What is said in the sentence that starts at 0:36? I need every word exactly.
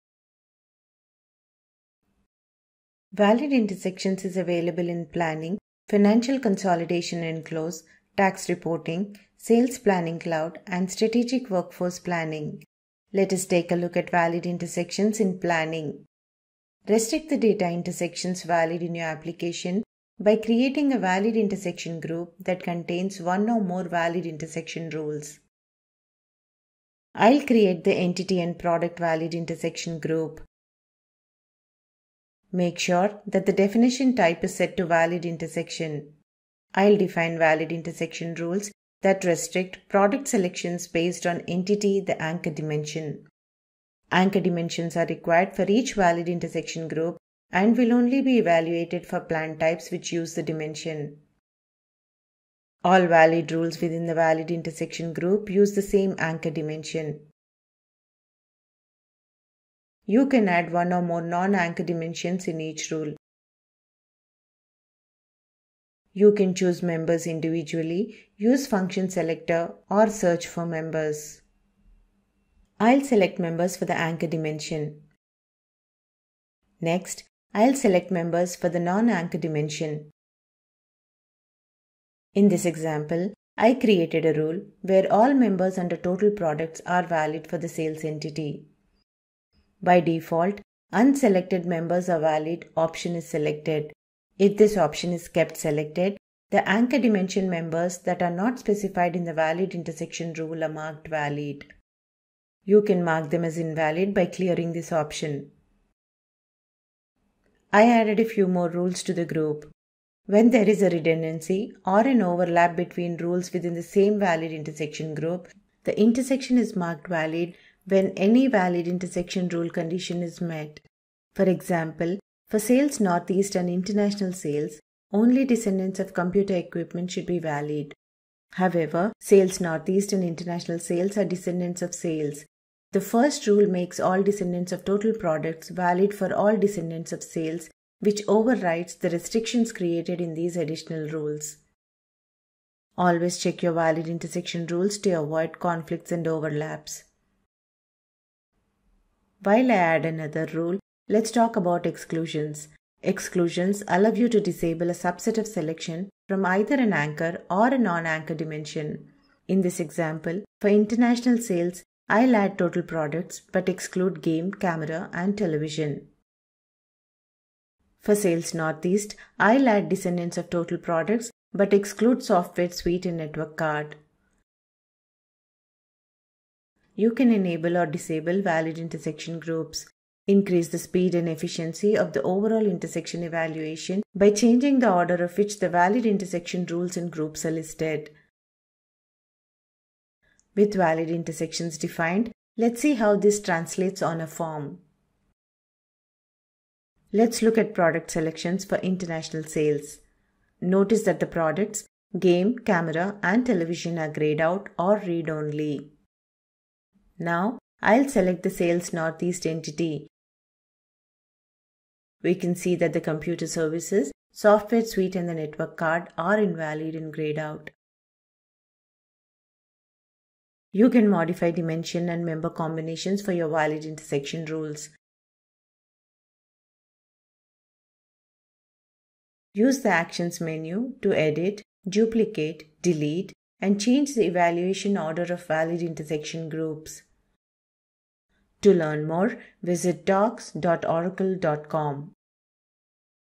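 I'll define valid intersection rules that restrict product selections based on entity the anchor dimension.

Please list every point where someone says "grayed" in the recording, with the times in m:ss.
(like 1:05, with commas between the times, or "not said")
3:24, 3:37.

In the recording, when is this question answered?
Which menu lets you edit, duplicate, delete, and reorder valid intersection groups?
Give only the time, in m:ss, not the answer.
3:49.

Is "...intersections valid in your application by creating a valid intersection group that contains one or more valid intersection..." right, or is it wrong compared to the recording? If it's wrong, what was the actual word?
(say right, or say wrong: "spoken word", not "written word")
right.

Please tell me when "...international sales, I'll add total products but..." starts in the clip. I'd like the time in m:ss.
2:40.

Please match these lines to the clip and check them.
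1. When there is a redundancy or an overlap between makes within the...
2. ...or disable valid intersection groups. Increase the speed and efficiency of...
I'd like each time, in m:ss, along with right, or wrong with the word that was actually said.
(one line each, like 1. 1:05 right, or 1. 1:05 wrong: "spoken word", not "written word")
1. 1:50 wrong: "rules", not "makes"
2. 2:57 right.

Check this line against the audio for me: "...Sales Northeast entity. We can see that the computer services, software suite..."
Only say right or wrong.
right.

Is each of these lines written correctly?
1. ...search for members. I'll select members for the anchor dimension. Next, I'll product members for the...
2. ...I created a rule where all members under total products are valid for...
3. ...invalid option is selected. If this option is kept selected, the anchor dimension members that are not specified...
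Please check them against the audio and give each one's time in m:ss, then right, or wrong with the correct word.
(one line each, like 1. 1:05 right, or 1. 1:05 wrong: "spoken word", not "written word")
1. 1:10 wrong: "select", not "product"
2. 1:23 right
3. 1:32 wrong: "valid", not "invalid".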